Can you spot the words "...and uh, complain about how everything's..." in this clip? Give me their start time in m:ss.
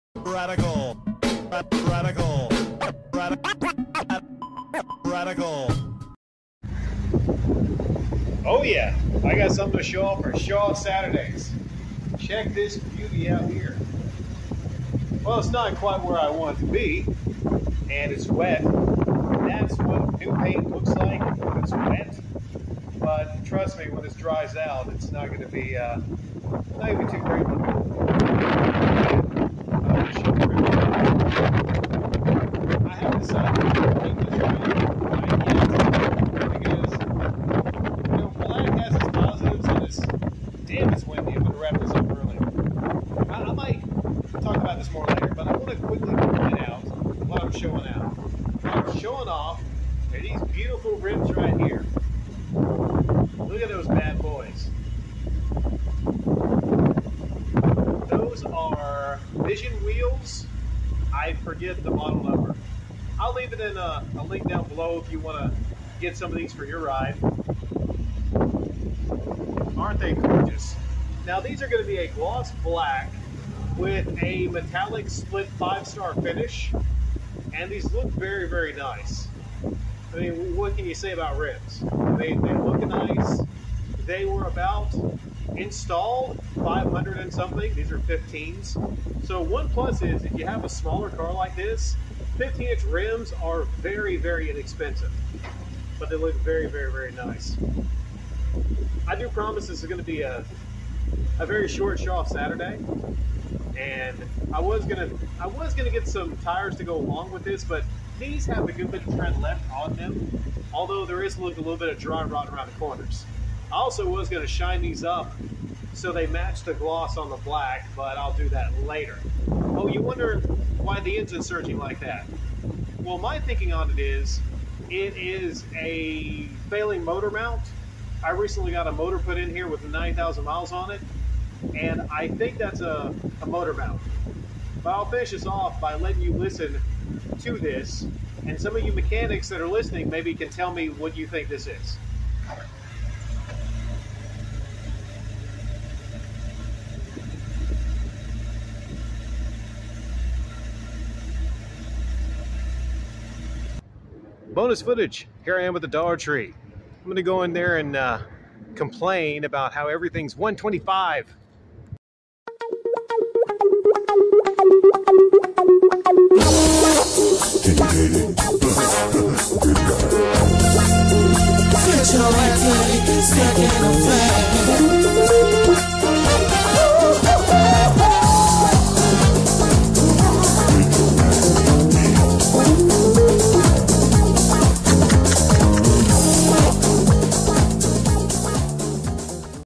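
2:37.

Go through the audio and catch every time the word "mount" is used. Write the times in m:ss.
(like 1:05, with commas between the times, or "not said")
2:07, 2:13.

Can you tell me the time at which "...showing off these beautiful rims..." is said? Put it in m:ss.
0:48.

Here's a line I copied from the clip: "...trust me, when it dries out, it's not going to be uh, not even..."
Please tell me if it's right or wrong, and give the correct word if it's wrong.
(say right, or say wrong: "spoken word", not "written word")
right.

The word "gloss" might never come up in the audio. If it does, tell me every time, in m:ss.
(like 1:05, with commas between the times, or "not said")
1:12, 1:56.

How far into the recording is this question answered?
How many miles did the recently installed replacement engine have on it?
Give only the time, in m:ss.
2:09.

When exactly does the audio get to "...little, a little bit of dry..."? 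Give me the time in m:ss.
1:51.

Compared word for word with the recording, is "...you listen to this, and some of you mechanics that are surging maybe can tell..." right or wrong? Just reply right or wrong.
wrong.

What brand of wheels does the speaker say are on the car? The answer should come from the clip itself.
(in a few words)
Vision Wheels.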